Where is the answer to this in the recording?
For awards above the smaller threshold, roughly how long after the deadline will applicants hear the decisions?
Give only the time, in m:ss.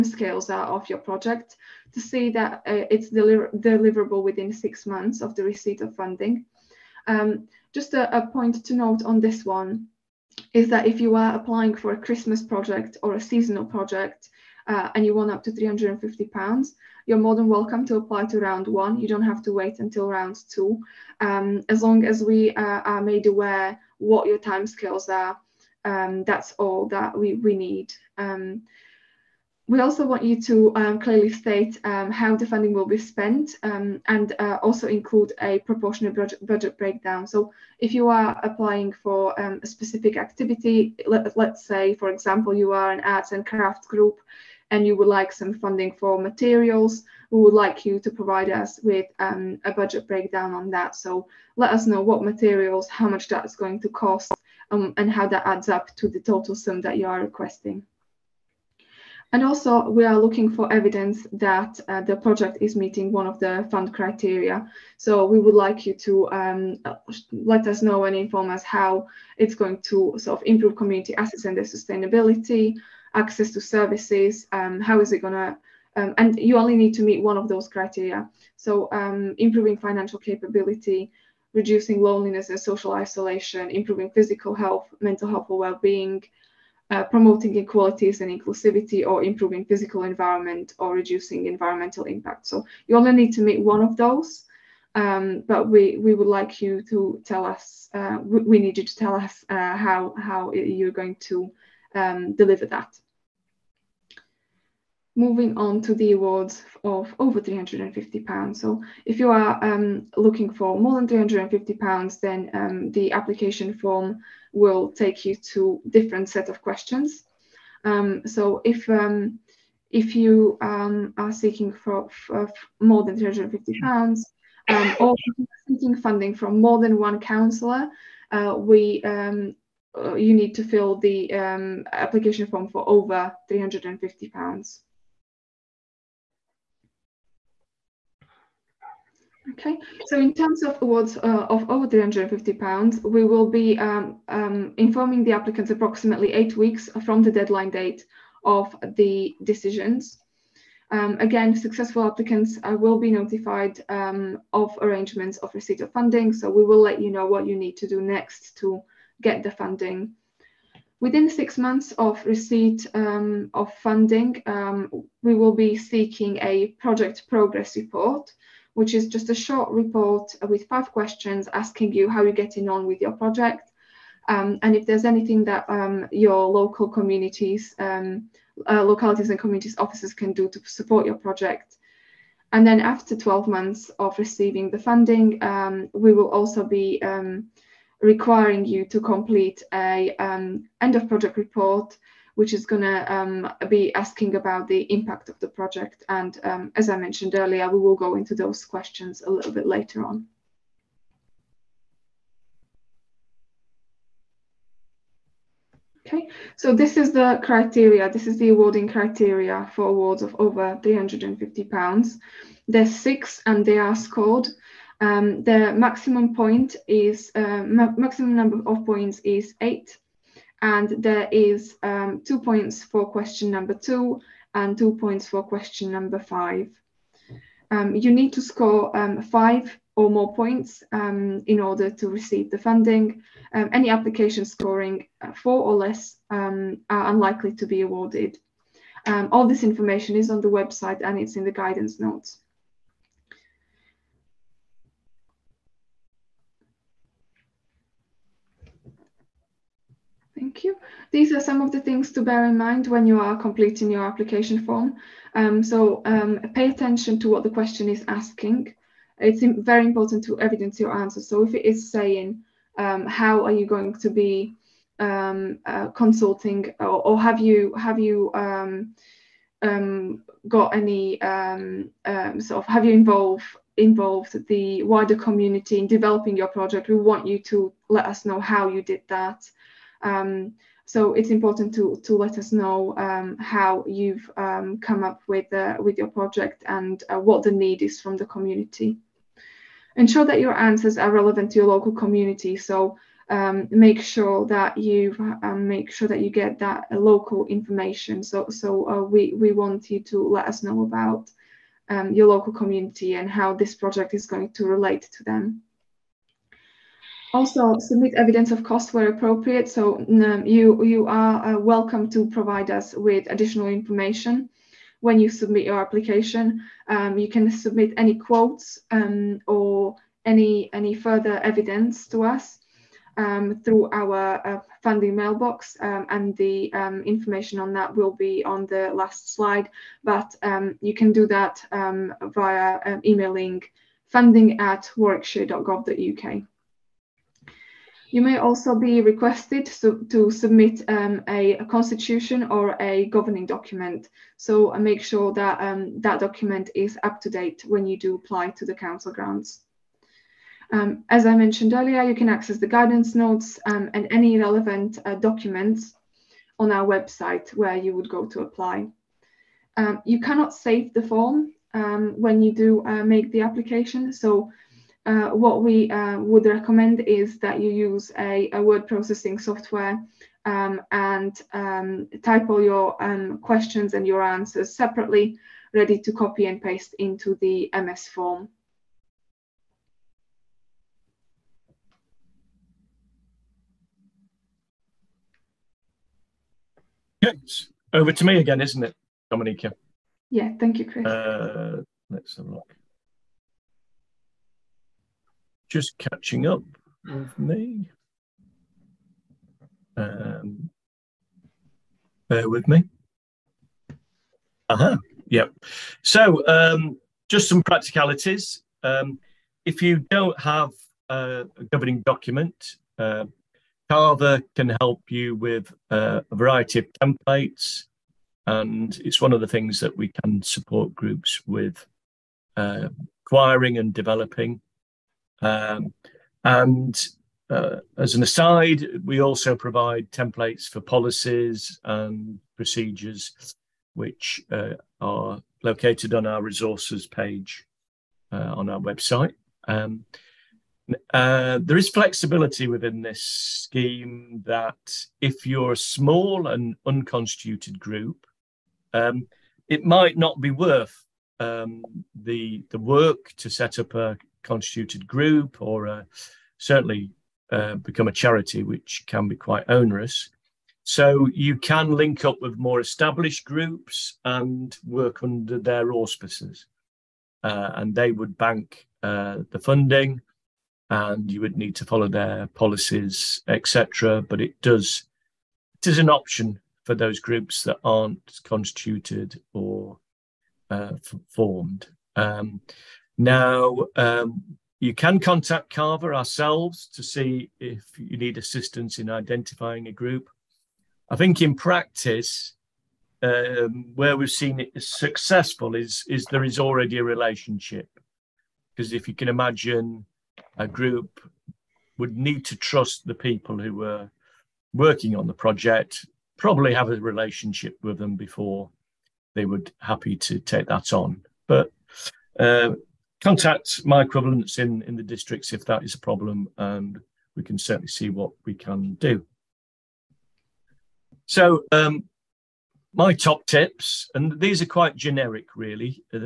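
2:26.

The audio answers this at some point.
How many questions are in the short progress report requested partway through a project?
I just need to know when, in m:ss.
2:50.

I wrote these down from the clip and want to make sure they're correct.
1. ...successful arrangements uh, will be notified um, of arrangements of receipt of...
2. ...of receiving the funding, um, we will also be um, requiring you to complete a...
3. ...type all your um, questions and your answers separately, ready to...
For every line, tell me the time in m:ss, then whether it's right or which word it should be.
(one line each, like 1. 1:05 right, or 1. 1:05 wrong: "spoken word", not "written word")
1. 2:31 wrong: "applicants", not "arrangements"
2. 3:03 right
3. 6:12 right.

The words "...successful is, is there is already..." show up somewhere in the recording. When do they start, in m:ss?
8:14.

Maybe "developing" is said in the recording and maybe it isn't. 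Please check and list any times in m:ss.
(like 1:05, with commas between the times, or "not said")
4:35, 7:03.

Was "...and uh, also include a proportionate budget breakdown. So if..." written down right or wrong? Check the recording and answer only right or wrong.
right.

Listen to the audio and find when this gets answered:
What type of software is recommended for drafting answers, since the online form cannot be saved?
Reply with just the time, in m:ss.
6:08.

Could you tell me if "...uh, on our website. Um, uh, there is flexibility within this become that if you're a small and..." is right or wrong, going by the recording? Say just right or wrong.
wrong.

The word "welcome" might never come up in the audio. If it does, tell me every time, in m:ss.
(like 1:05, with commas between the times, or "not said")
0:17, 5:11.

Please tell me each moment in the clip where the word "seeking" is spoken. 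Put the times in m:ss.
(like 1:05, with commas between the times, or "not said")
2:01, 2:05, 2:45.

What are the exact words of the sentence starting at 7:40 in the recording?
So you can link up with more established groups and work under their auspices.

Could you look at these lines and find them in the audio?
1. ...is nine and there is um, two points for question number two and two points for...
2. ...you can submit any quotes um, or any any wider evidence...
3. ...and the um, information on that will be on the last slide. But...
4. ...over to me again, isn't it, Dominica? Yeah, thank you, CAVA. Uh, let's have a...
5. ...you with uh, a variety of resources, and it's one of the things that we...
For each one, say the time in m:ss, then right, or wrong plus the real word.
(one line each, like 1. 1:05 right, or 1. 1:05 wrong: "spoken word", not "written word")
1. 3:39 wrong: "eight", not "nine"
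2. 5:17 wrong: "further", not "wider"
3. 5:26 right
4. 6:27 wrong: "Chris", not "CAVA"
5. 6:55 wrong: "templates", not "resources".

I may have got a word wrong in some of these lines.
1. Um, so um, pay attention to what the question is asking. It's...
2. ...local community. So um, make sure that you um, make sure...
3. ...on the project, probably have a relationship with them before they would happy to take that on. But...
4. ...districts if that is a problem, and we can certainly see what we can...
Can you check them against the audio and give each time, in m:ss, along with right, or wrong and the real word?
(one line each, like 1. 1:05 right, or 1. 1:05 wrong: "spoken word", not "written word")
1. 4:15 right
2. 4:51 right
3. 8:25 right
4. 8:35 right.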